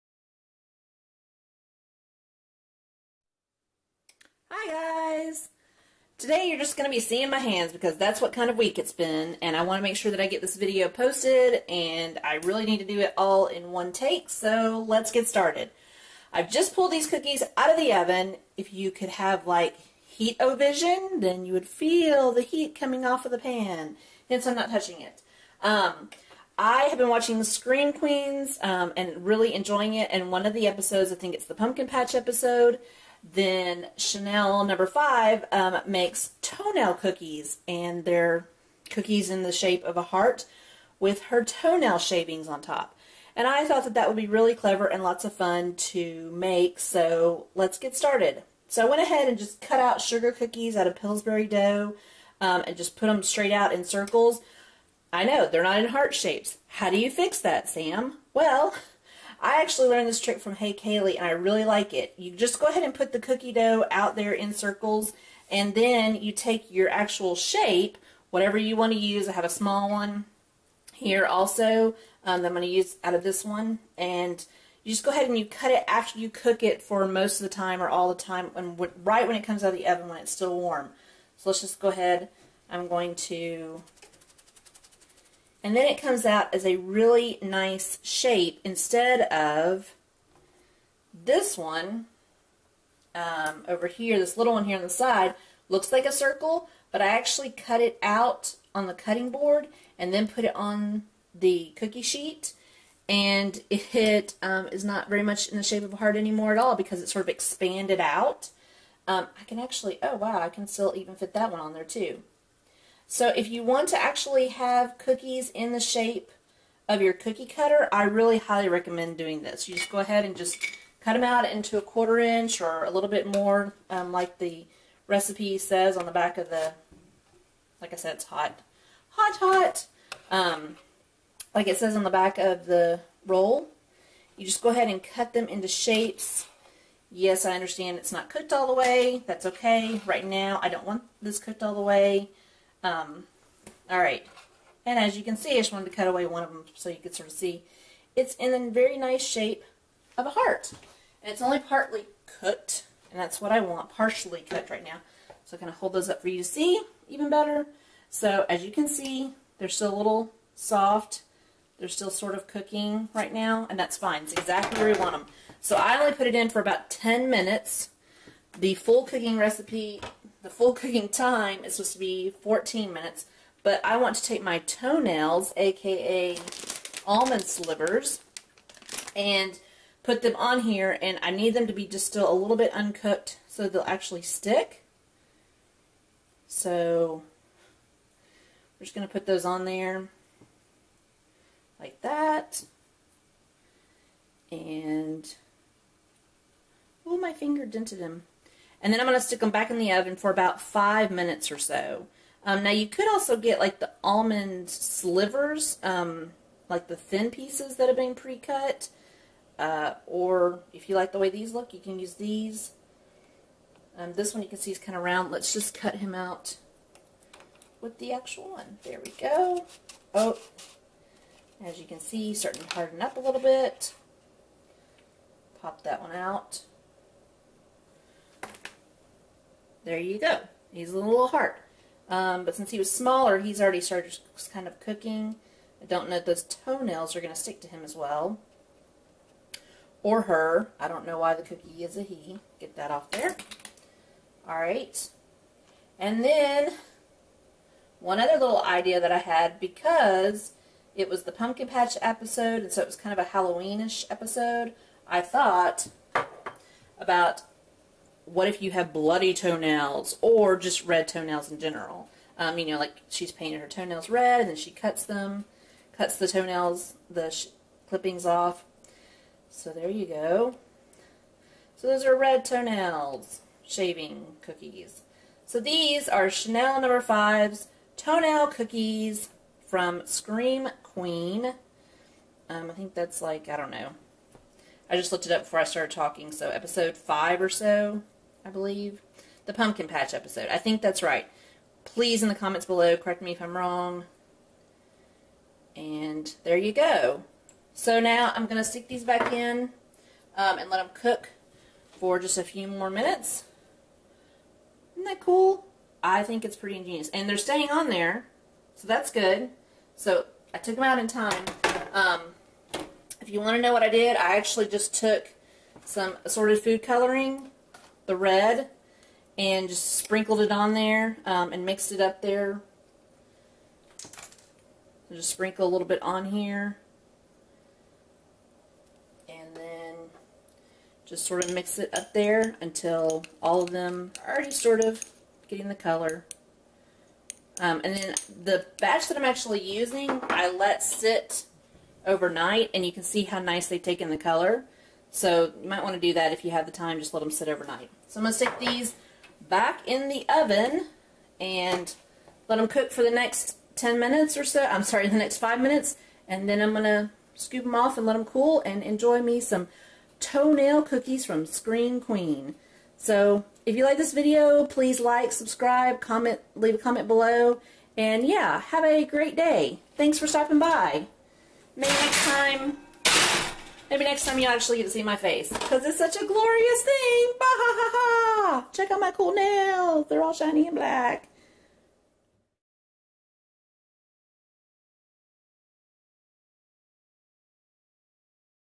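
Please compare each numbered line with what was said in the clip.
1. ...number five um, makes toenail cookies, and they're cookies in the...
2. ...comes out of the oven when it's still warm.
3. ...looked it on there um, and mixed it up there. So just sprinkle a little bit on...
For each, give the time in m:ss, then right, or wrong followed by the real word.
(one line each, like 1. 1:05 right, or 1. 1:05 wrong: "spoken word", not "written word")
1. 0:34 right
2. 1:19 right
3. 5:19 wrong: "sprinkled", not "looked".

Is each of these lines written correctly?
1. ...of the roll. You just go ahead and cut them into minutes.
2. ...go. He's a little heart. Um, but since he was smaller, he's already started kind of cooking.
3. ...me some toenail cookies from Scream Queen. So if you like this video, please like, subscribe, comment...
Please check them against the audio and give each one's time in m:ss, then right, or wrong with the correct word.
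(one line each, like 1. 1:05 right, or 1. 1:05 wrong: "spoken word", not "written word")
1. 2:12 wrong: "shapes", not "minutes"
2. 3:50 right
3. 5:59 right.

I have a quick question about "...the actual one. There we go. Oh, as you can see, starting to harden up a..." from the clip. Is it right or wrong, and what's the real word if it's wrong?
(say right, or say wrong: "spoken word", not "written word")
right.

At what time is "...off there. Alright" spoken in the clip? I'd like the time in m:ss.
4:02.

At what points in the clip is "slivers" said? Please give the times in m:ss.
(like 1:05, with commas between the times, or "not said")
2:57, 3:24.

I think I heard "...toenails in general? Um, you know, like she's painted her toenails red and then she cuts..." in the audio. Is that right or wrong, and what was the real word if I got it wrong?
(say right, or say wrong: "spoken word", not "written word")
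right.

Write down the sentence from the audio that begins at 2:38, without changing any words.
So as you can see, they're still a little soft.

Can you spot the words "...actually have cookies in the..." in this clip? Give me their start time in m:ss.
1:54.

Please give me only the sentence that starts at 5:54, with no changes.
I'm sorry, the next 5 minutes.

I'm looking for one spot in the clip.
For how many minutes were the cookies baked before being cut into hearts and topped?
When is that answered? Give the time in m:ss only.
2:46.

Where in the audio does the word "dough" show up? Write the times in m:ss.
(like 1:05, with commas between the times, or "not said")
0:51, 1:03.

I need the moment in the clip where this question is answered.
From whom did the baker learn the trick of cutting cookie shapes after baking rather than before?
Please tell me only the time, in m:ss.
1:00.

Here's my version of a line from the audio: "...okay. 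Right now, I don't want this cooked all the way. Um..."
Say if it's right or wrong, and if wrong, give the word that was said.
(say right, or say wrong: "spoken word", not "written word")
right.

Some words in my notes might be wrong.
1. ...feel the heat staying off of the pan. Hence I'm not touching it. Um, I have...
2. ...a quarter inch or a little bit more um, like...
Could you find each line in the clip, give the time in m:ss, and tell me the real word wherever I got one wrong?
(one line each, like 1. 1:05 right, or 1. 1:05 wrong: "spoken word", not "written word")
1. 0:21 wrong: "coming", not "staying"
2. 2:01 right.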